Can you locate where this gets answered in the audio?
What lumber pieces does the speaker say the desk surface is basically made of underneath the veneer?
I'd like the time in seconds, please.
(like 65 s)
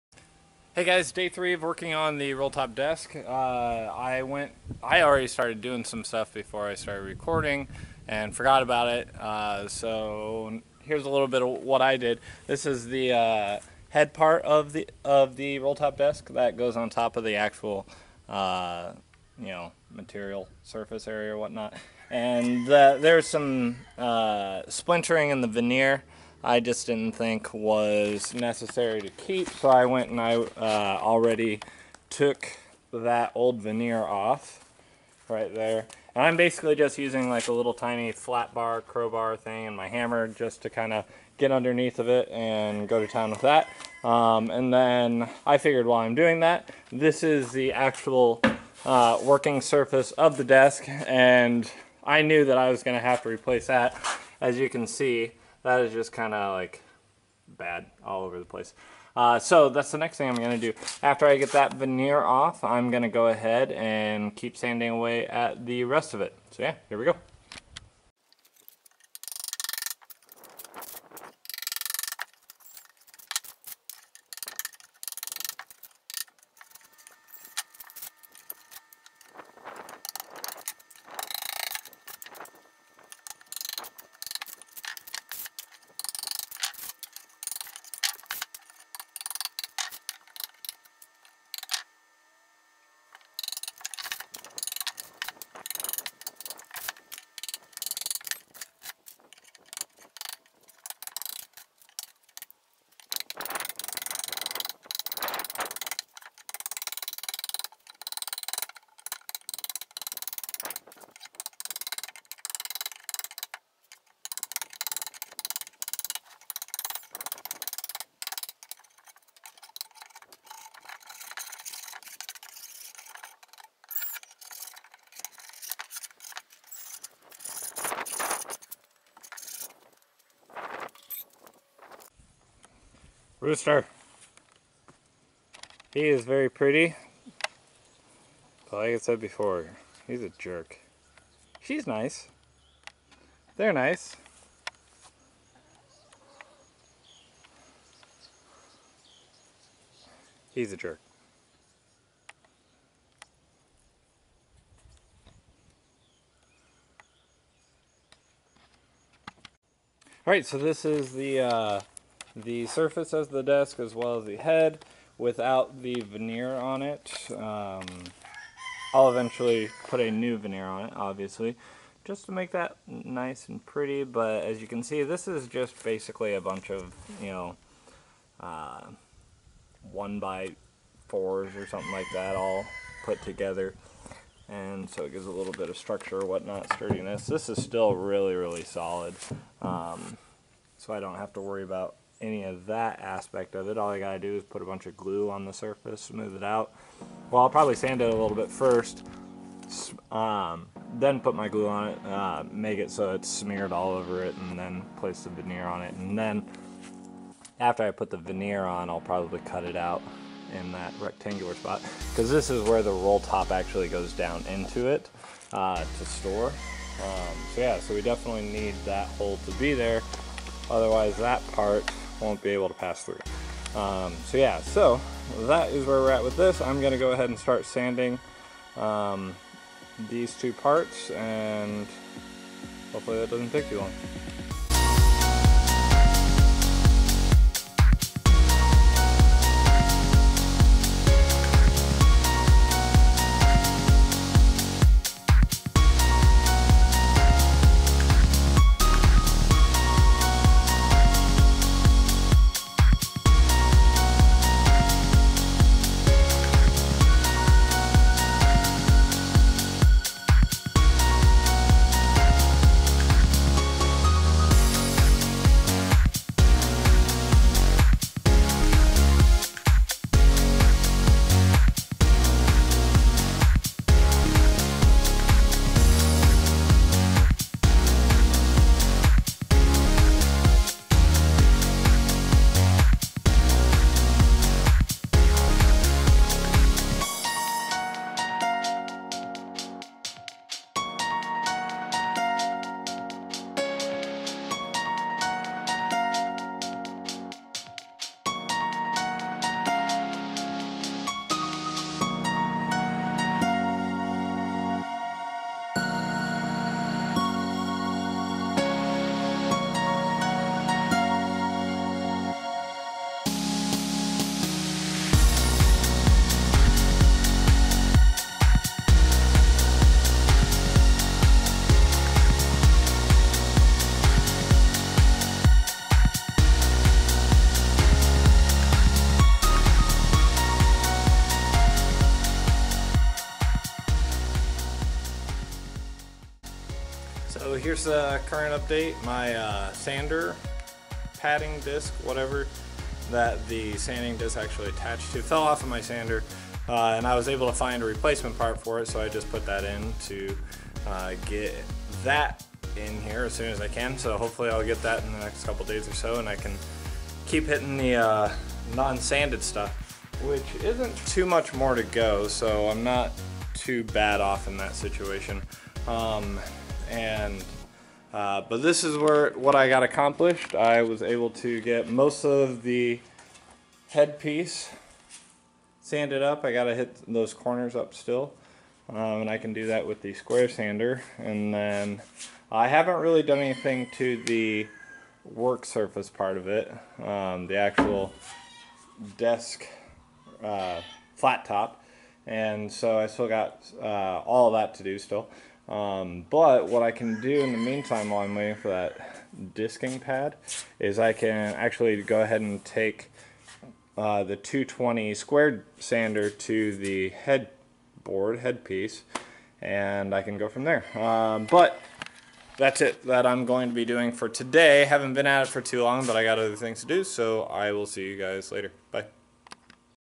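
179 s.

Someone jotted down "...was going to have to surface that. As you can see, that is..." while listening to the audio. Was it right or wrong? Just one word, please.
wrong.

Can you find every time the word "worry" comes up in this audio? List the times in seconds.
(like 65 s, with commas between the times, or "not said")
191 s.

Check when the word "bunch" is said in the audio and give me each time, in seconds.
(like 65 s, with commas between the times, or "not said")
176 s, 194 s.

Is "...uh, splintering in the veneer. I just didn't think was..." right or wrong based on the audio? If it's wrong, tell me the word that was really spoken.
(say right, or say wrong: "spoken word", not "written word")
right.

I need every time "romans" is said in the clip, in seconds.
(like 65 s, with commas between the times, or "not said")
not said.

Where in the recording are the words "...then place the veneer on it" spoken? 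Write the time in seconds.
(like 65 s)
204 s.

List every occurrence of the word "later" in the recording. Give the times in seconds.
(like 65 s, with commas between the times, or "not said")
418 s.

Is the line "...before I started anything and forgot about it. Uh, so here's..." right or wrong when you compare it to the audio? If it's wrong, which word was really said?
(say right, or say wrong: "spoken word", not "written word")
wrong: "recording", not "anything".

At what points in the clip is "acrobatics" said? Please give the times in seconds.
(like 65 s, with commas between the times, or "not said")
not said.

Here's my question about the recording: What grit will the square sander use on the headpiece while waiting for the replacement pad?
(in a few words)
220.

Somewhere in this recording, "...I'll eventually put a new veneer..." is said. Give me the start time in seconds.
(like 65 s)
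168 s.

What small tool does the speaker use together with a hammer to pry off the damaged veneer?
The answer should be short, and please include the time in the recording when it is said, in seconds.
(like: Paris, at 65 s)
Flat bar, at 37 s.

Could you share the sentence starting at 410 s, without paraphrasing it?
Um, but that's it that I'm going to be doing for today.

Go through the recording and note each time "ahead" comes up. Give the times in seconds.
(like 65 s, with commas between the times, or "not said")
63 s, 227 s, 402 s.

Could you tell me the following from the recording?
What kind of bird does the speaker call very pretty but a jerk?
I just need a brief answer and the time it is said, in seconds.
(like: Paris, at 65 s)
Rooster, at 133 s.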